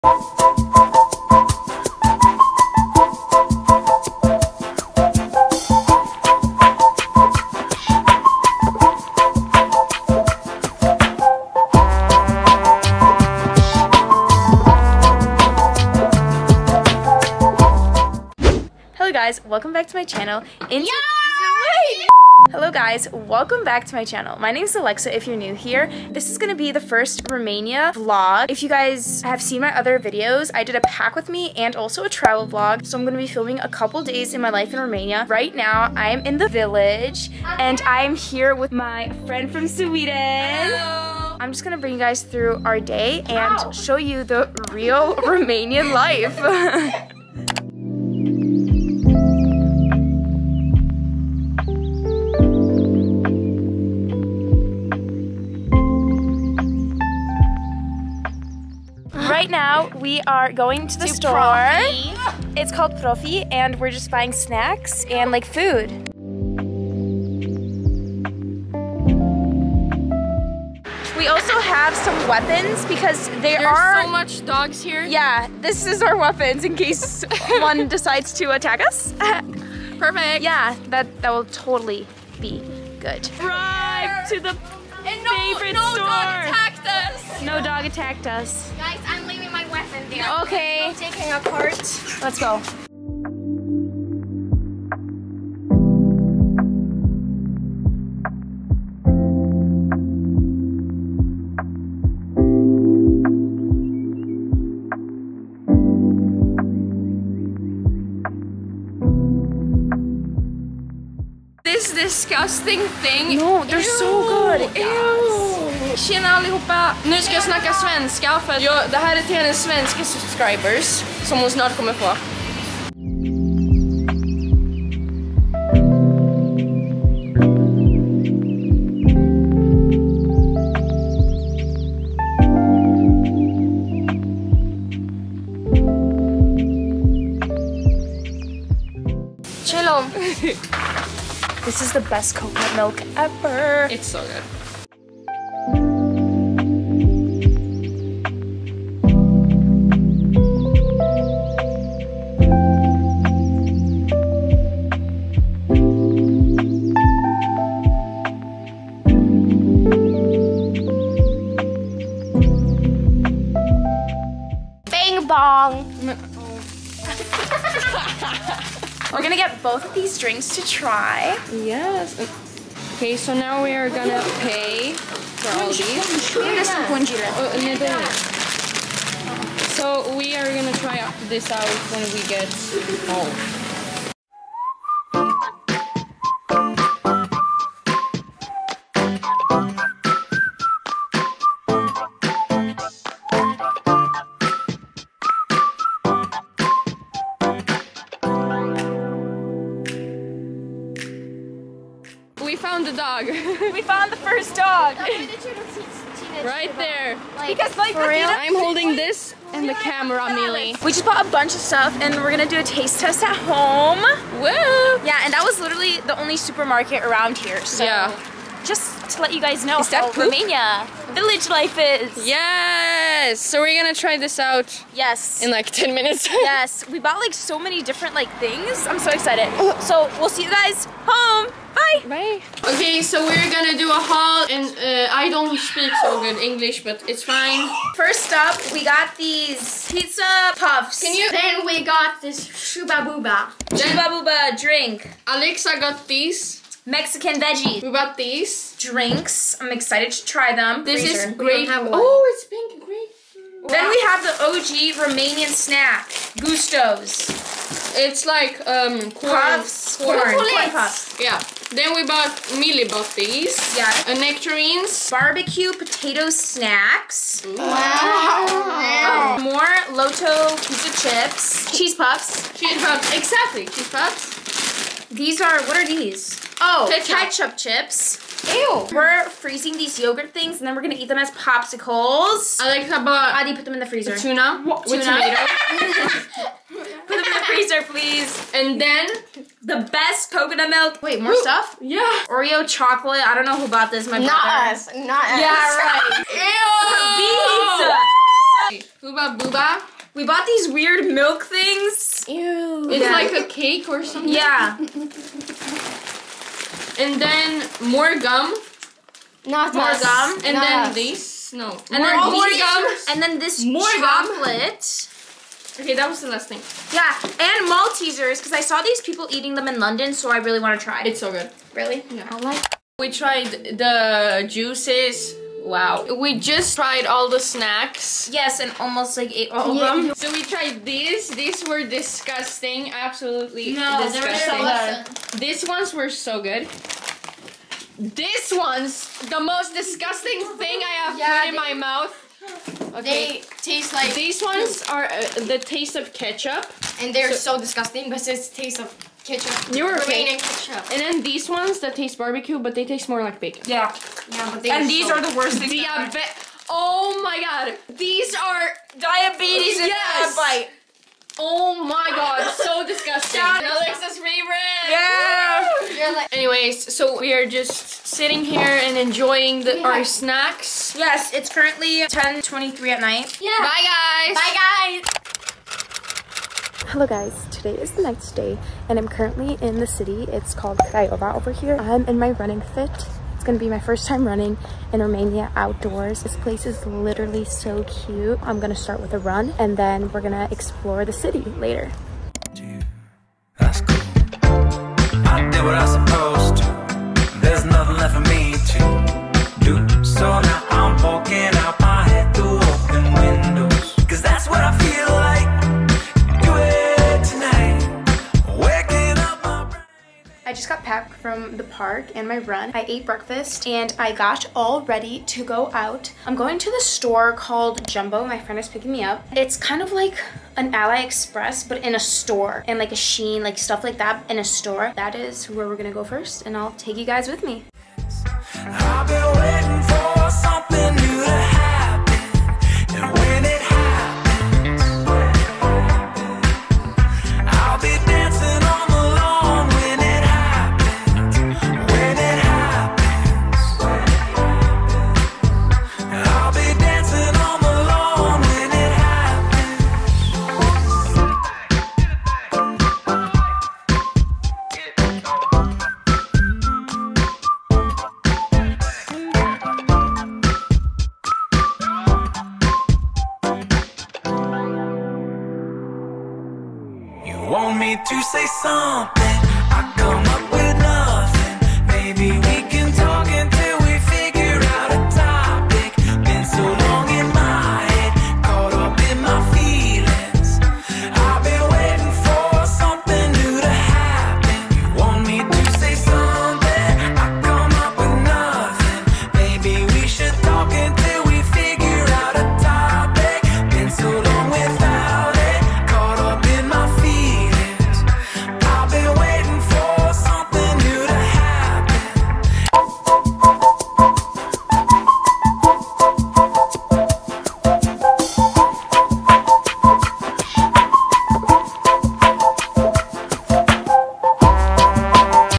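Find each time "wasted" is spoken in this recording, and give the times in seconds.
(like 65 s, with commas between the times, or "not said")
not said.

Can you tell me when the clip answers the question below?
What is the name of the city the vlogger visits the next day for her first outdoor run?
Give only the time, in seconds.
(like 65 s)
380 s.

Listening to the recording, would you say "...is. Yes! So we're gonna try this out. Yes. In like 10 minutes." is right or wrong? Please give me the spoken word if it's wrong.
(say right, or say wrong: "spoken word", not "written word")
right.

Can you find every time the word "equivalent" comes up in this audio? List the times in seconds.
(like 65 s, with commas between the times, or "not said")
not said.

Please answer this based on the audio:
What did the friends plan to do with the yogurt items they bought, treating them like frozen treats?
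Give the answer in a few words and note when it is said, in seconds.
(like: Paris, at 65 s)
Eat them as popsicles, at 280 s.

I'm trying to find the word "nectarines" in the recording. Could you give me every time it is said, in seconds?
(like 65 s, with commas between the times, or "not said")
264 s.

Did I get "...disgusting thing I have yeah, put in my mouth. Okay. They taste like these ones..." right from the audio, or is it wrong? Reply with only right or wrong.
right.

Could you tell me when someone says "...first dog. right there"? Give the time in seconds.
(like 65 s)
204 s.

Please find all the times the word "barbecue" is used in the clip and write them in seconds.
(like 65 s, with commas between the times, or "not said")
265 s, 352 s.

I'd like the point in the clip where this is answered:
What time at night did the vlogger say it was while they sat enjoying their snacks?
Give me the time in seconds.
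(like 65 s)
372 s.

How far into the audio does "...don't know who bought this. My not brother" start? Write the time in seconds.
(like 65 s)
293 s.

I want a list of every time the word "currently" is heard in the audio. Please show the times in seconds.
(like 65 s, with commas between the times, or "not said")
371 s, 379 s.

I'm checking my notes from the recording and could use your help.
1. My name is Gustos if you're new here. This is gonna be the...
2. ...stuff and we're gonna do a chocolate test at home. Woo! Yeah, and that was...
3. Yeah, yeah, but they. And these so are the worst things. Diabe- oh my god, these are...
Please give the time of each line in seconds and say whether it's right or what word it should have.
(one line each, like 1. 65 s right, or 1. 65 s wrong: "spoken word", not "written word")
1. 24 s wrong: "Alexa", not "Gustos"
2. 211 s wrong: "taste", not "chocolate"
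3. 353 s right.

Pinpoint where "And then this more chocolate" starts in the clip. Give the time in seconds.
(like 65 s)
313 s.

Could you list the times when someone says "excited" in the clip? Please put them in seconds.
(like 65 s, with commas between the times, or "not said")
229 s, 249 s.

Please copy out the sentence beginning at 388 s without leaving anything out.
I'm gonna start with a run and then we're gonna explore the city later.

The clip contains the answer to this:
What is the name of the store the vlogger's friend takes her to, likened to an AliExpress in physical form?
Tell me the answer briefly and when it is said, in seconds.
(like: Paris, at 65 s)
Jumbo, at 417 s.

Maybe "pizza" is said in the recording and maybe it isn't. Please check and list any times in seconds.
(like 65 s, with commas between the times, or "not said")
239 s, 270 s, 298 s.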